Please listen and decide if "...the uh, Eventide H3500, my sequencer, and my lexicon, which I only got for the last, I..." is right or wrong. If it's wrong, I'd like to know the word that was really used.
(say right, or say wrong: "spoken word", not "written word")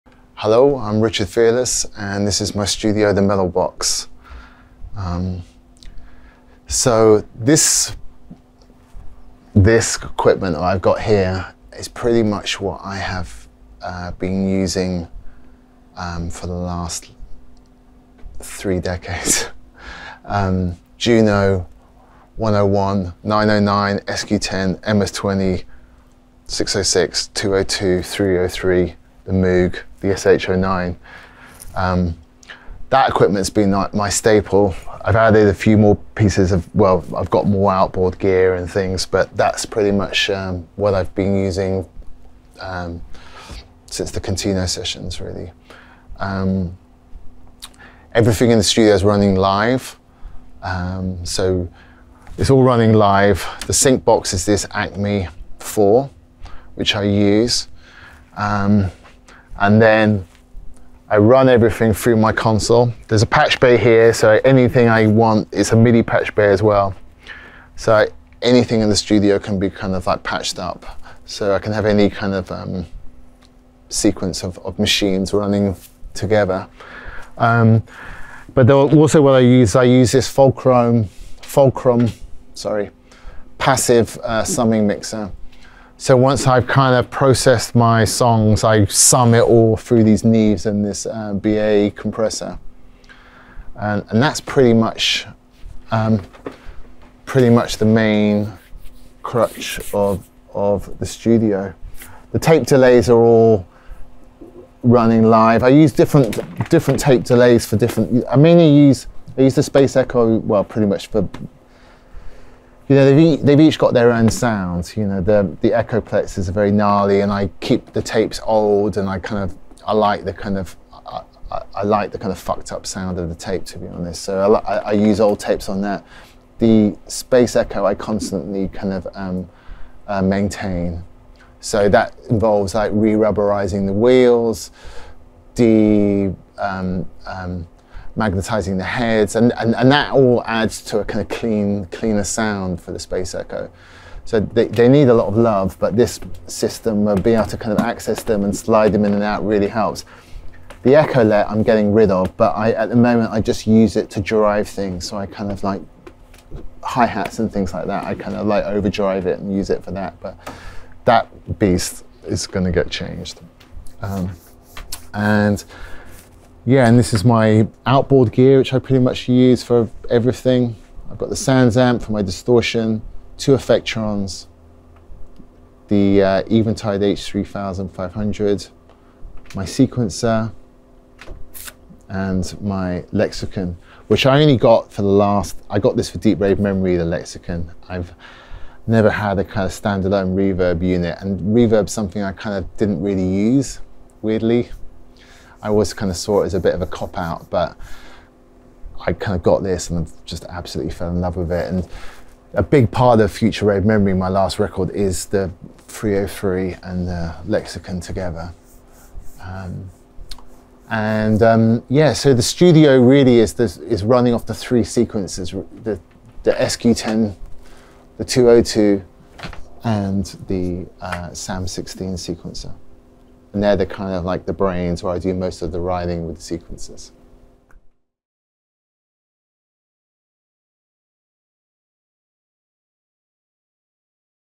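right.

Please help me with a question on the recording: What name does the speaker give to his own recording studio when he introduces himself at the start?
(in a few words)
The Metal Box.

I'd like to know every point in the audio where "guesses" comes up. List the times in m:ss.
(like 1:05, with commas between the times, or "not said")
not said.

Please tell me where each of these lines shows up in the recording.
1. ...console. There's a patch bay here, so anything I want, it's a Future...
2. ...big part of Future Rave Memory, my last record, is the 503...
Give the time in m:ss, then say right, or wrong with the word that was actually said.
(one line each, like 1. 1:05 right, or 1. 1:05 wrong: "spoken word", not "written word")
1. 1:02 wrong: "MIDI", not "Future"
2. 3:22 wrong: "303", not "503".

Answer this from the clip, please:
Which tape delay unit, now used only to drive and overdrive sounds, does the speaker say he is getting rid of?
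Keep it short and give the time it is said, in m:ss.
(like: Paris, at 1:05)
Echolette, at 2:30.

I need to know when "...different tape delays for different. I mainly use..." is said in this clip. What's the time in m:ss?
1:46.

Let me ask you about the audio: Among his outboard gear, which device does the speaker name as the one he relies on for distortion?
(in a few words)
SansAmp.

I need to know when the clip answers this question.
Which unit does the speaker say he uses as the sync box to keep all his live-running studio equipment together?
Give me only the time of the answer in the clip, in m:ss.
0:54.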